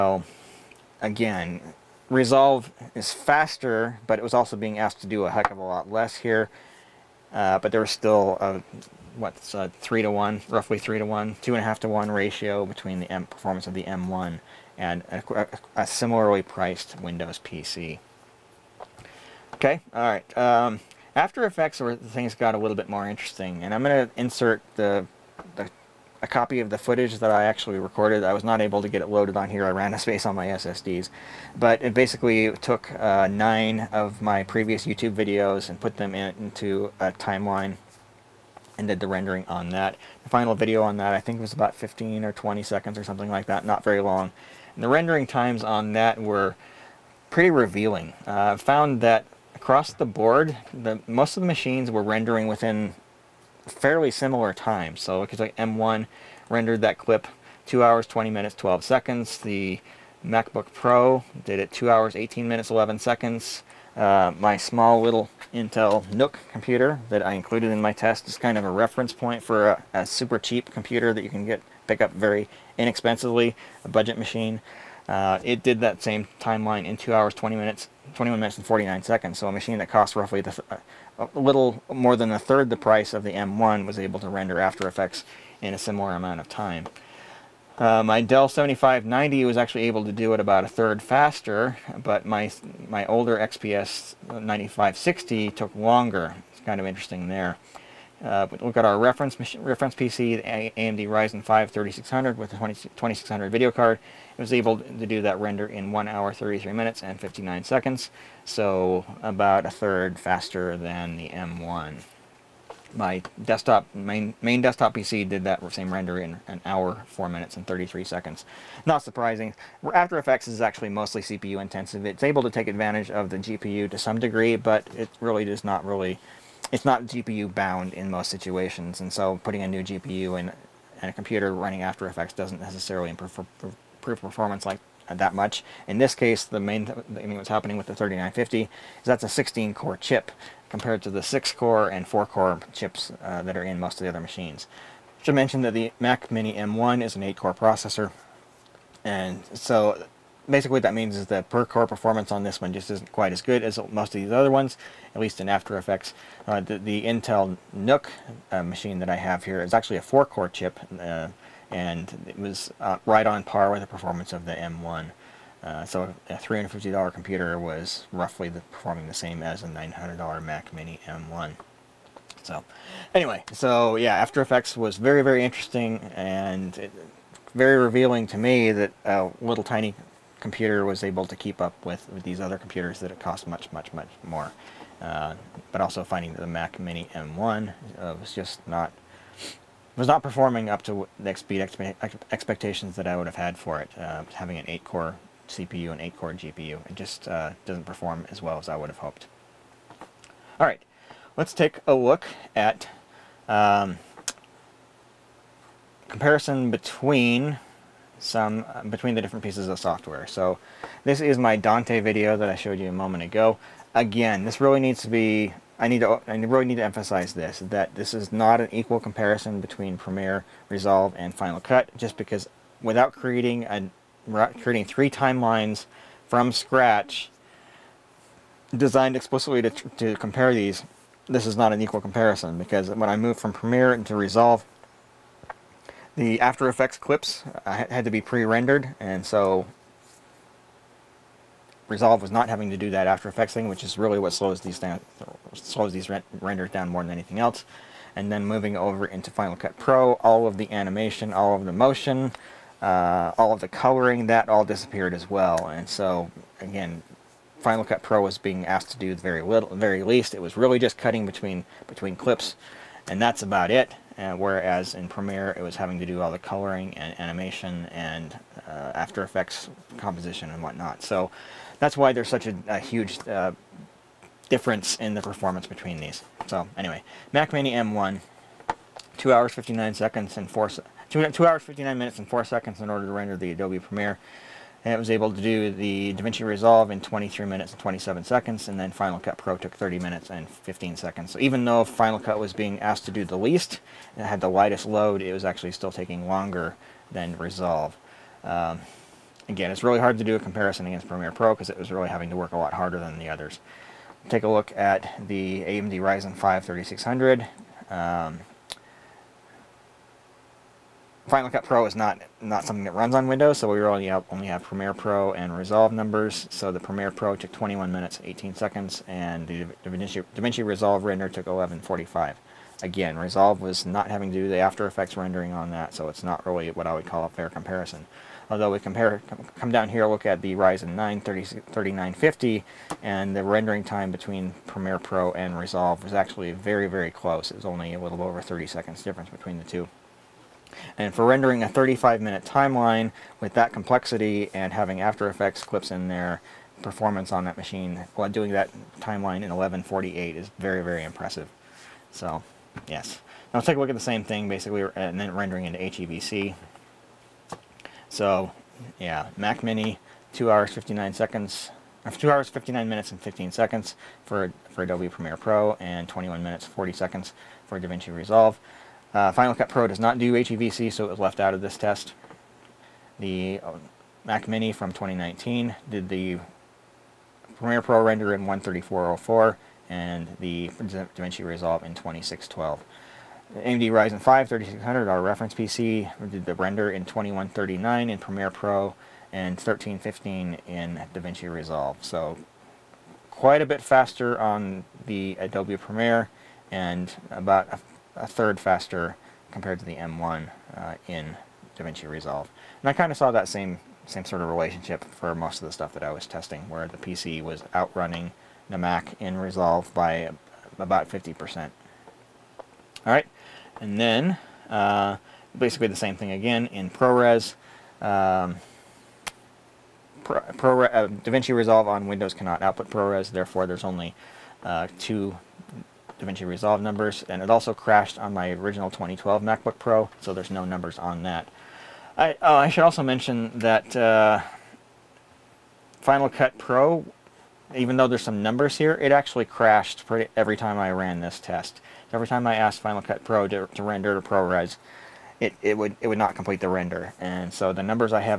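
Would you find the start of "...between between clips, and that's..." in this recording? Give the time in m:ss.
4:21.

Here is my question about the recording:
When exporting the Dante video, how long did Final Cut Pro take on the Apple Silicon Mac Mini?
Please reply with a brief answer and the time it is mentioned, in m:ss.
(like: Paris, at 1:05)
30 minutes 15 seconds, at 4:49.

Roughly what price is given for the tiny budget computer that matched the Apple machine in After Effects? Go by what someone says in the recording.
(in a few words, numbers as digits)
$350.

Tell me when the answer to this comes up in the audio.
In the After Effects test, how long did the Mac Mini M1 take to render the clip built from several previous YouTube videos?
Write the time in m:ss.
0:57.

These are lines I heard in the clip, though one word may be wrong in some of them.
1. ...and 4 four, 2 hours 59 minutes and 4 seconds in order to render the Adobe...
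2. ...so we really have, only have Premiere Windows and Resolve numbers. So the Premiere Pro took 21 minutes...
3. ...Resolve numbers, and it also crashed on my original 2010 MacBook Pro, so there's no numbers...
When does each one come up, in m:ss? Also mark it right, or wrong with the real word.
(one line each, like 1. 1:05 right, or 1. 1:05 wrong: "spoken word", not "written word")
1. 4:40 wrong: "two", not "four"
2. 5:13 wrong: "Pro", not "Windows"
3. 7:06 wrong: "2012", not "2010".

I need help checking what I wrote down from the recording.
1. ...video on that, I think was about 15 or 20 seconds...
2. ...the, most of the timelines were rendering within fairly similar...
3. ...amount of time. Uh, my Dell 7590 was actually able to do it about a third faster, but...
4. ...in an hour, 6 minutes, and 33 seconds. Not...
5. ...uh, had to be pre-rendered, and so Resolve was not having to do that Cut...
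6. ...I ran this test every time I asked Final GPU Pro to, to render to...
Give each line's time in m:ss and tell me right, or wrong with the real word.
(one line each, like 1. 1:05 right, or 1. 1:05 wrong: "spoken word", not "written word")
1. 0:40 right
2. 0:50 wrong: "machines", not "timelines"
3. 1:26 right
4. 1:56 wrong: "4", not "6"
5. 3:57 wrong: "After", not "Cut"
6. 7:20 wrong: "Cut", not "GPU".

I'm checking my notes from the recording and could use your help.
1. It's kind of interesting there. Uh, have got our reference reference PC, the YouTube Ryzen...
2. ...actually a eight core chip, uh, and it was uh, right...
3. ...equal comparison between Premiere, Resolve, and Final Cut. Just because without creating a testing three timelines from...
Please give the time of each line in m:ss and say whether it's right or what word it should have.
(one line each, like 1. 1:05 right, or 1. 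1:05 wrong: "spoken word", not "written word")
1. 1:36 wrong: "AMD", not "YouTube"
2. 2:39 wrong: "four", not "eight"
3. 3:38 wrong: "creating", not "testing".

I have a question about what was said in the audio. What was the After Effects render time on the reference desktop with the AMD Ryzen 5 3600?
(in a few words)
1 hour, 33 minutes, 59 seconds.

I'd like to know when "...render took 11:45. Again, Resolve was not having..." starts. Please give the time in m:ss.
5:21.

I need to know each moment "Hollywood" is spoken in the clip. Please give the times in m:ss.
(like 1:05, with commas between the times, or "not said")
not said.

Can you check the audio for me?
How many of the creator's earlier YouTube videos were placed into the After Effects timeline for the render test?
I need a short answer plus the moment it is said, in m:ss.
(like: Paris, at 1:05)
9, at 0:33.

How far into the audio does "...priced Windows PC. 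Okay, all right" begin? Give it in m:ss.
0:16.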